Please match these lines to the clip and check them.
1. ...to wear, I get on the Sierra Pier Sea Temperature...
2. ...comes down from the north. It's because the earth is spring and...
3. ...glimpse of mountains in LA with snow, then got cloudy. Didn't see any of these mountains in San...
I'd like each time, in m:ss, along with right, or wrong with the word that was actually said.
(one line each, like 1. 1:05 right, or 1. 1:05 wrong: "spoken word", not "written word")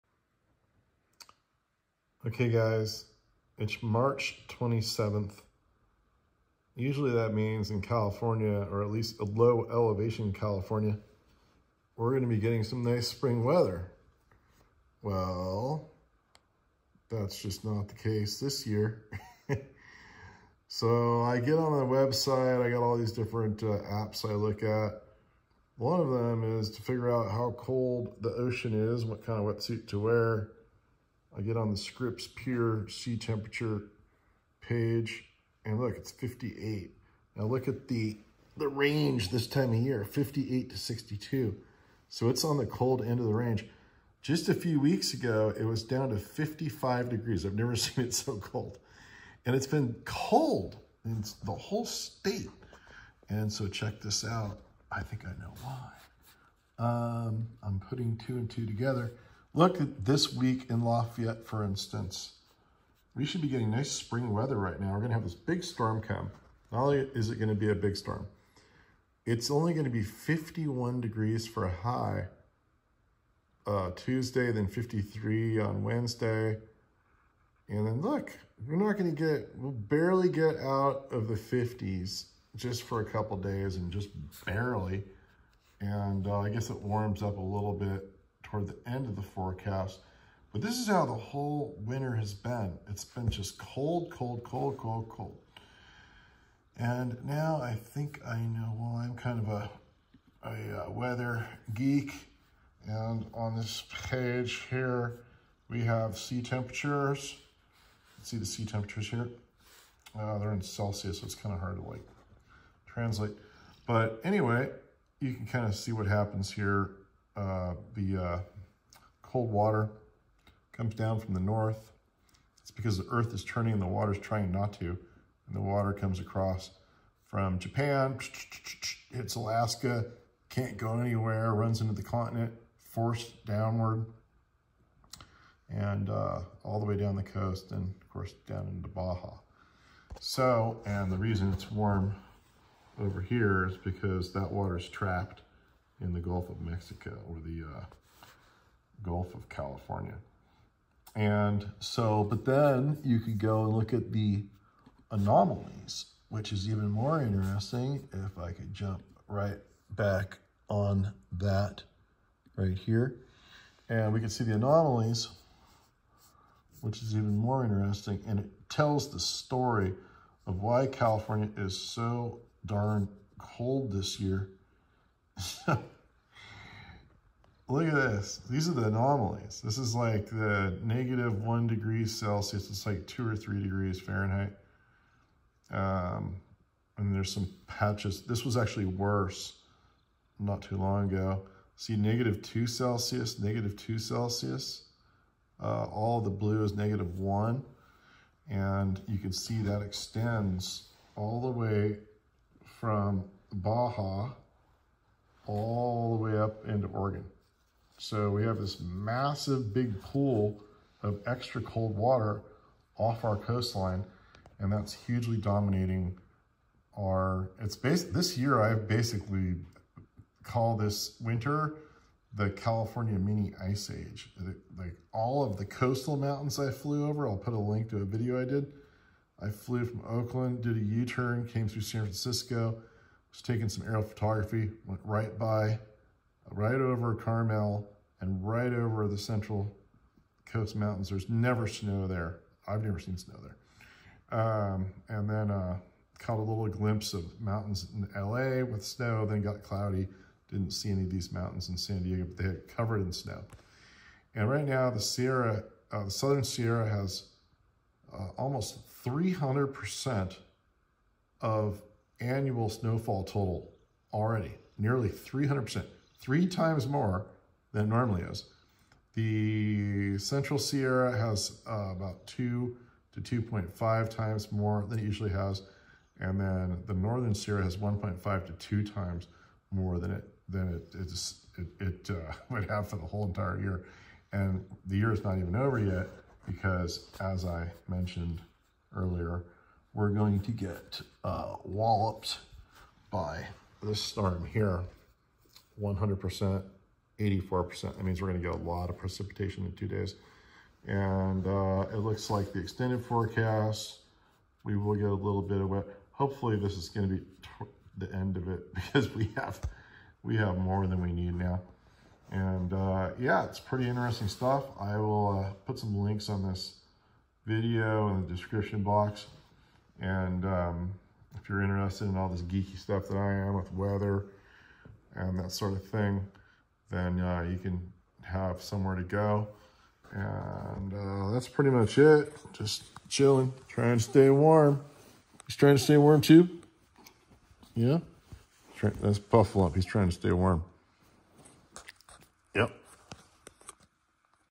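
1. 0:29 wrong: "Scripps", not "Sierra"
2. 2:00 wrong: "turning", not "spring"
3. 4:06 right.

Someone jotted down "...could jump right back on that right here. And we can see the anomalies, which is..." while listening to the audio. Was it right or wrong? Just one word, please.
right.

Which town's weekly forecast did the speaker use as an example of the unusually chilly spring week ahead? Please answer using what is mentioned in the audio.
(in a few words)
Lafayette.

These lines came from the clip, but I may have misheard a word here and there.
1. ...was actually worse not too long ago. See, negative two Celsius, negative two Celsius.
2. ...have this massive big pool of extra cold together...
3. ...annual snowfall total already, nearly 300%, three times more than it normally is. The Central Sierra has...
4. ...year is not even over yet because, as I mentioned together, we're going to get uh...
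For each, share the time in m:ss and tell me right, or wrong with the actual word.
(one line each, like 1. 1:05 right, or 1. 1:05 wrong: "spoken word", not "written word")
1. 3:08 right
2. 3:28 wrong: "water", not "together"
3. 4:22 right
4. 4:44 wrong: "earlier", not "together".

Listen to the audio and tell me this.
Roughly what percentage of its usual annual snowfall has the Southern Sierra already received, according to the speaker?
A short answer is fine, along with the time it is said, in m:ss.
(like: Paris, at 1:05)
300%, at 4:18.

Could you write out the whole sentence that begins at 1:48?
Let's see the sea temperatures here.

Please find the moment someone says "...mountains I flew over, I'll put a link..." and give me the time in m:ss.
3:46.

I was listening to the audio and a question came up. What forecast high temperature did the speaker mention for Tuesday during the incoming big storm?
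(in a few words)
51 degrees.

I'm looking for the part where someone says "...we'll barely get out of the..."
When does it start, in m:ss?
1:19.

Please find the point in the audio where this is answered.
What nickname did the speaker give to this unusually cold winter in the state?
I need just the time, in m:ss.
3:42.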